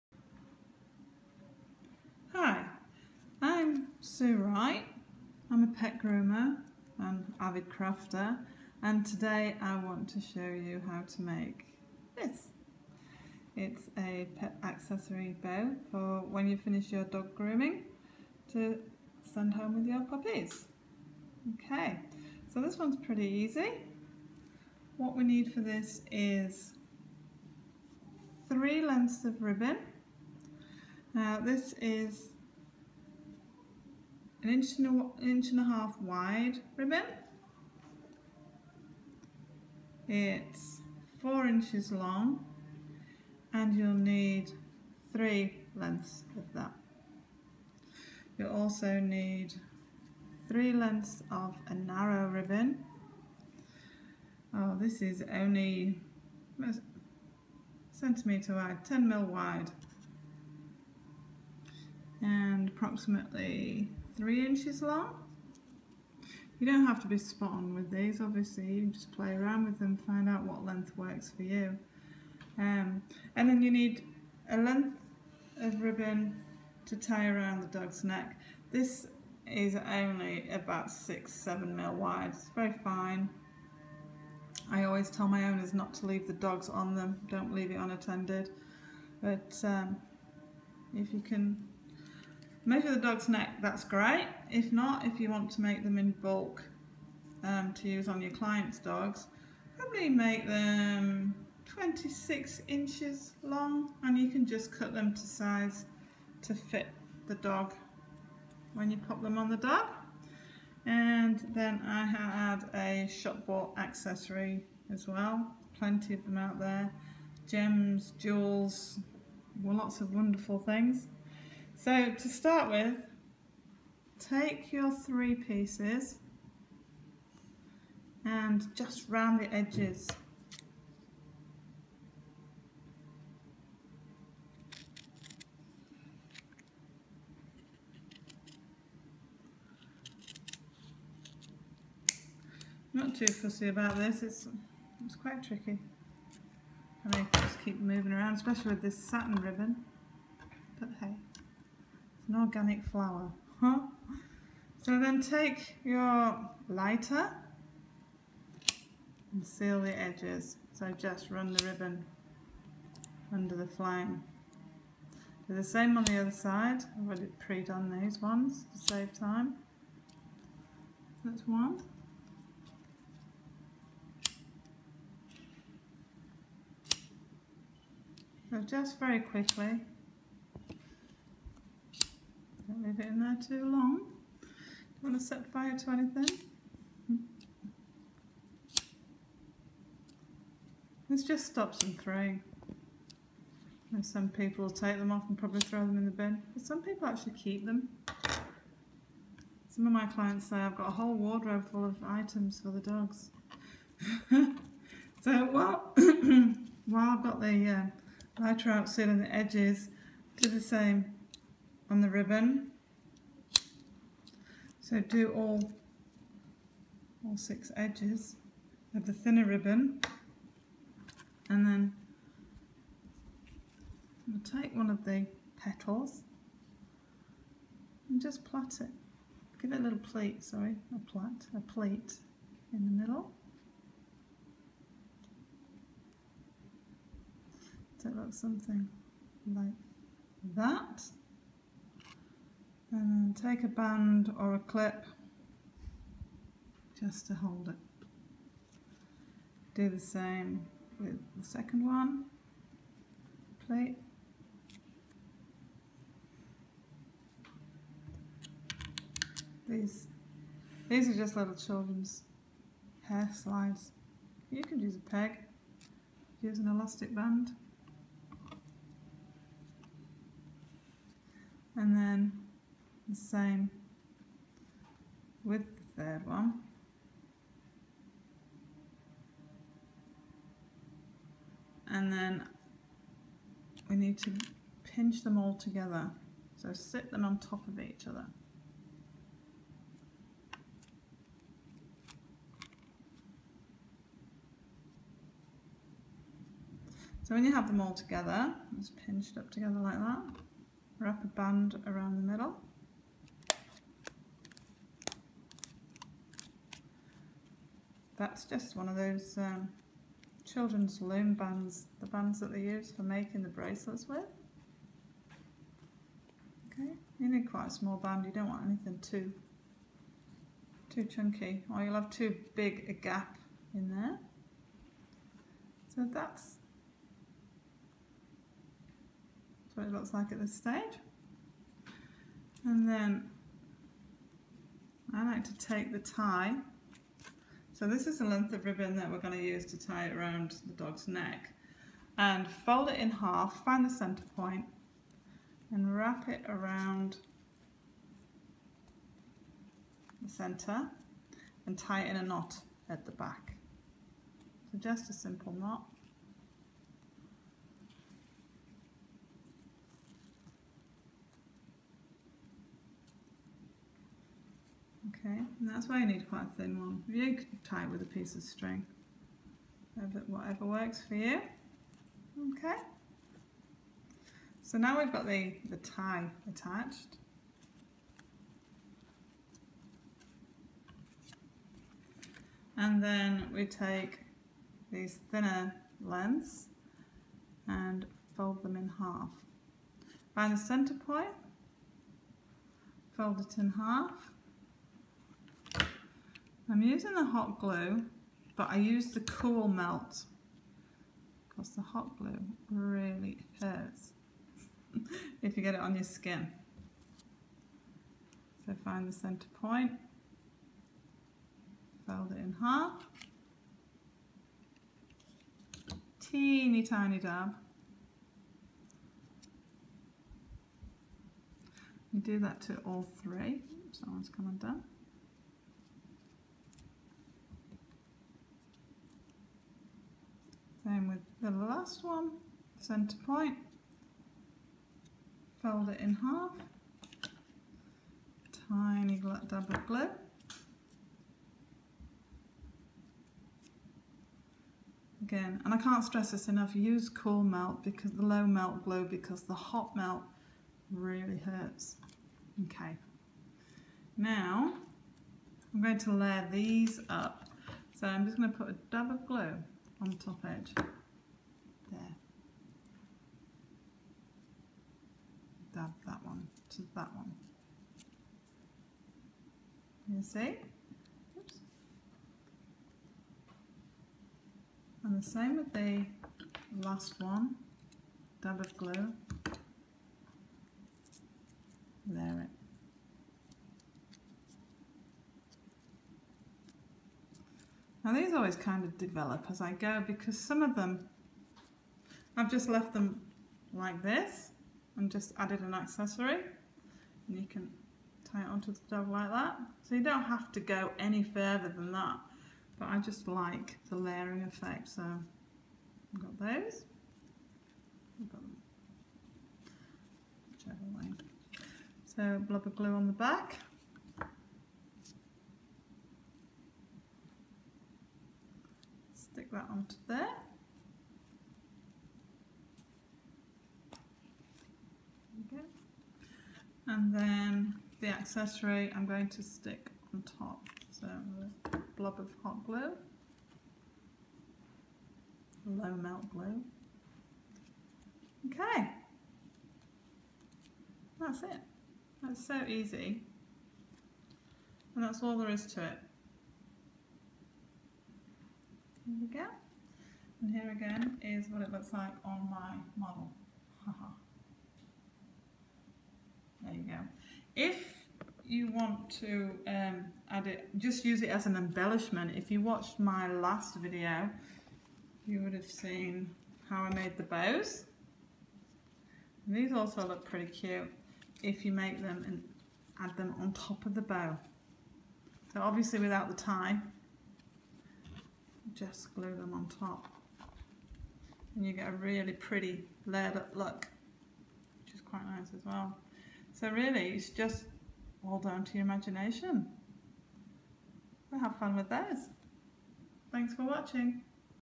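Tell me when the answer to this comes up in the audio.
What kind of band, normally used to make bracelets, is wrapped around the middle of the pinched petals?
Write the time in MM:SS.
05:11.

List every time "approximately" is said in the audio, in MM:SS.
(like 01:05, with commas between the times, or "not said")
01:02.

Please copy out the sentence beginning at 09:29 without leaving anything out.
And these also look pretty cute if you make them and add them on top of the bow.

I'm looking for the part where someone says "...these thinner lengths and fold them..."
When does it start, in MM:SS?
06:24.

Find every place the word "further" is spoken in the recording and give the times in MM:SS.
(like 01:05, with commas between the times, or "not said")
08:21.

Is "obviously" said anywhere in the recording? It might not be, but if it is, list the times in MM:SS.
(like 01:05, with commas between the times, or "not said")
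01:08, 09:35.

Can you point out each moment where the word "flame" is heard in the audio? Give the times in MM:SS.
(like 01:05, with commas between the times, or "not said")
02:43.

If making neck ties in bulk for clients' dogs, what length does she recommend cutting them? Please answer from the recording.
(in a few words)
26 inches.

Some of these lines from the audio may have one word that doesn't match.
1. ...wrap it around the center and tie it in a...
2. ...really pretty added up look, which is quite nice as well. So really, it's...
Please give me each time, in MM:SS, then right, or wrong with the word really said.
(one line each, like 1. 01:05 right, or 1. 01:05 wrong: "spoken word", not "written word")
1. 05:45 right
2. 09:41 wrong: "layered", not "added".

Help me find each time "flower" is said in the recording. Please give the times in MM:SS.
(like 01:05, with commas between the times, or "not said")
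02:32.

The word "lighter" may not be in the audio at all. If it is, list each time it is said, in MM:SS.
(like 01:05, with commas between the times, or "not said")
02:36, 03:28.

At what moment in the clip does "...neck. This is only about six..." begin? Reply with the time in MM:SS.
01:18.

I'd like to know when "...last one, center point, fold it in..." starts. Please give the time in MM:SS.
07:11.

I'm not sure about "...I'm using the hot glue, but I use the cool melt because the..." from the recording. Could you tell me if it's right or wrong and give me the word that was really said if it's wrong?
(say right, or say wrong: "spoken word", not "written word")
right.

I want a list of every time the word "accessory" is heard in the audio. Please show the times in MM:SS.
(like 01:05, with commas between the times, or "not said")
00:14, 01:53, 08:15, 08:48.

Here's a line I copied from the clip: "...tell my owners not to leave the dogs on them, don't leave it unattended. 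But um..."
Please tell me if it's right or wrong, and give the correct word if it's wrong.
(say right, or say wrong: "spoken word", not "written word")
right.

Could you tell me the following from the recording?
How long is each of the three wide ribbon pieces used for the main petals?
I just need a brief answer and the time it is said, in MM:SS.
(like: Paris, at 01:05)
4 inches, at 00:41.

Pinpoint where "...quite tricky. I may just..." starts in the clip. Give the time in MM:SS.
02:25.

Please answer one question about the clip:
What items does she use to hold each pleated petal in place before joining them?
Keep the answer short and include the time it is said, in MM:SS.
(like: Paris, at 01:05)
Children's hair slides, at 04:21.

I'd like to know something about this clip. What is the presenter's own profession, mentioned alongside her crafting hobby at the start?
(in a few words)
Pet groomer.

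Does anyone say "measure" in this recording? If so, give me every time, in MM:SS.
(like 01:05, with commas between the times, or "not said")
01:32.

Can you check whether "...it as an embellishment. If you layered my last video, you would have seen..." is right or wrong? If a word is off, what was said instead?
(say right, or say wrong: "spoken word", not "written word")
wrong: "watched", not "layered".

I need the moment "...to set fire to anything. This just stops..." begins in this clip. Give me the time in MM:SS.
03:05.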